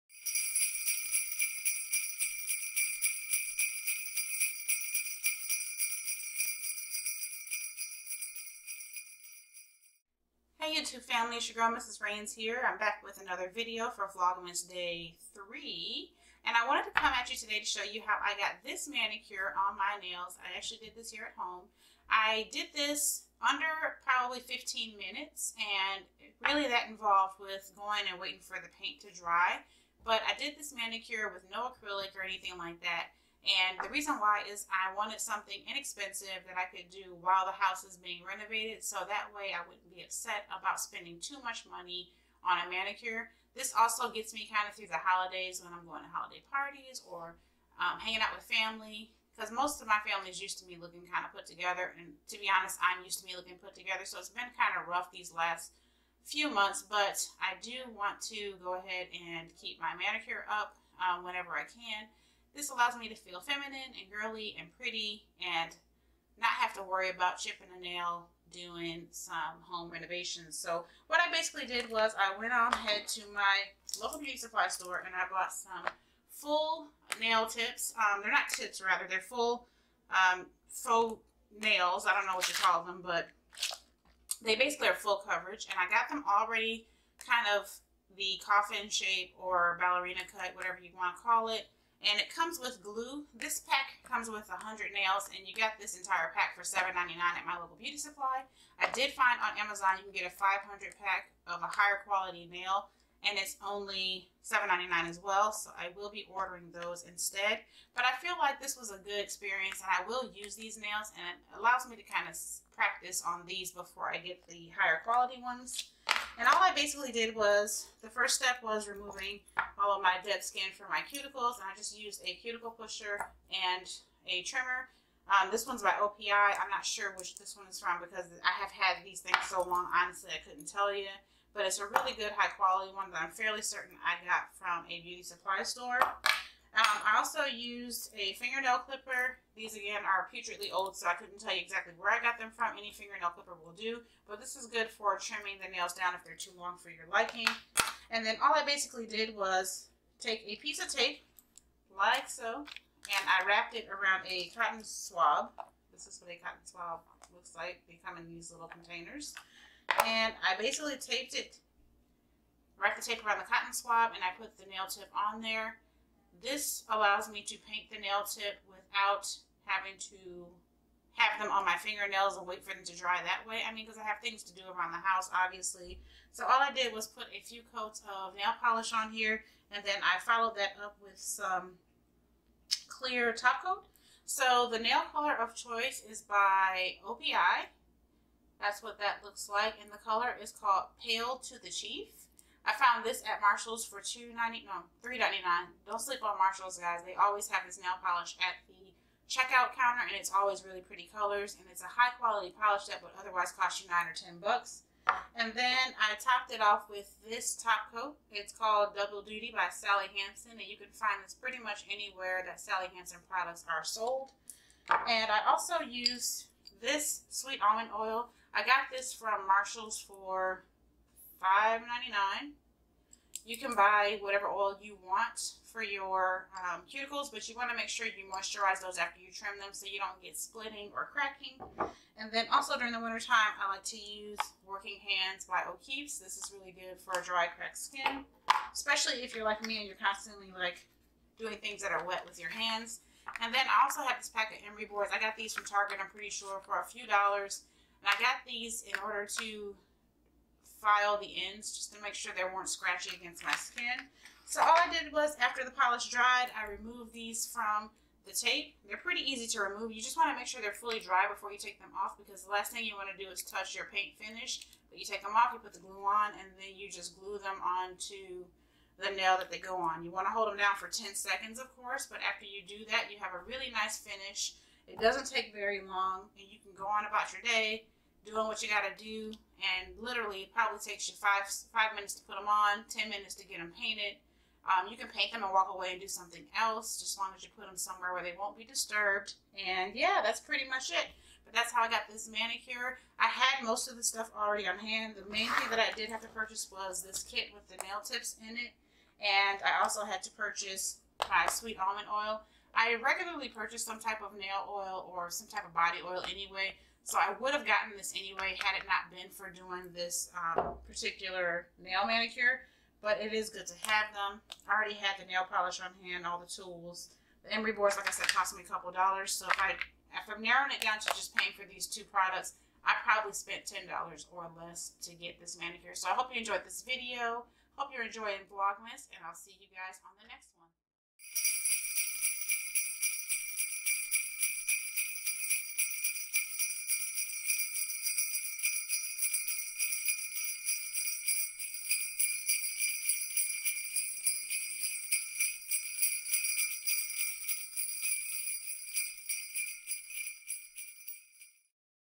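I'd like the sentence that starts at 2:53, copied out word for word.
I mean, because I have things to do around the house, obviously.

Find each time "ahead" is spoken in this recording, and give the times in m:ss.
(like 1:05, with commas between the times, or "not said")
0:58, 1:12.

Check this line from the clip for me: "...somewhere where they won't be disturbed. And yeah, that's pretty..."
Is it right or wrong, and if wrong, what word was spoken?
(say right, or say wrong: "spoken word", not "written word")
right.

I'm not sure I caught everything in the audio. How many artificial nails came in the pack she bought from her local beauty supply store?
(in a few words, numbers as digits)
100.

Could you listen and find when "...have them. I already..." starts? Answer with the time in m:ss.
5:13.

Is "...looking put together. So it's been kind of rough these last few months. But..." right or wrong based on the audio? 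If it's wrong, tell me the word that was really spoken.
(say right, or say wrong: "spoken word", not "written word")
right.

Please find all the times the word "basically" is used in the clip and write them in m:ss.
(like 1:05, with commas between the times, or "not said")
1:11, 1:24, 1:56, 2:28, 2:40.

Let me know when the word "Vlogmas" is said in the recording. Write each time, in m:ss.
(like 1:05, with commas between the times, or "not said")
0:14, 5:28.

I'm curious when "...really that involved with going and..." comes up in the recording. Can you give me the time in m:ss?
0:26.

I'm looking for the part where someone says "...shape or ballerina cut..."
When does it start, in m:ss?
1:28.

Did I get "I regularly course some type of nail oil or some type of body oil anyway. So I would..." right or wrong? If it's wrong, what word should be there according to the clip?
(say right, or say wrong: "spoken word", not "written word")
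wrong: "purchase", not "course".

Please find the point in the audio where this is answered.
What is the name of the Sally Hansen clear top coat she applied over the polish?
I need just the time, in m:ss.
3:28.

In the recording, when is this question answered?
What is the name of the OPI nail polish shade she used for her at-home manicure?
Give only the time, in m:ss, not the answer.
3:11.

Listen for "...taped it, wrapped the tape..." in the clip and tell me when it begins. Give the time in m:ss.
2:40.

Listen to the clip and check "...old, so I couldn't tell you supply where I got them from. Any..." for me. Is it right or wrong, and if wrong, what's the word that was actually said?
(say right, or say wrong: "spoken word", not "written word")
wrong: "exactly", not "supply".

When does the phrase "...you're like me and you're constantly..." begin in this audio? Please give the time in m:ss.
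3:59.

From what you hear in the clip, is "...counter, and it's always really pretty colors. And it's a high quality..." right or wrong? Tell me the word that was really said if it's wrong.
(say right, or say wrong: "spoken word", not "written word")
right.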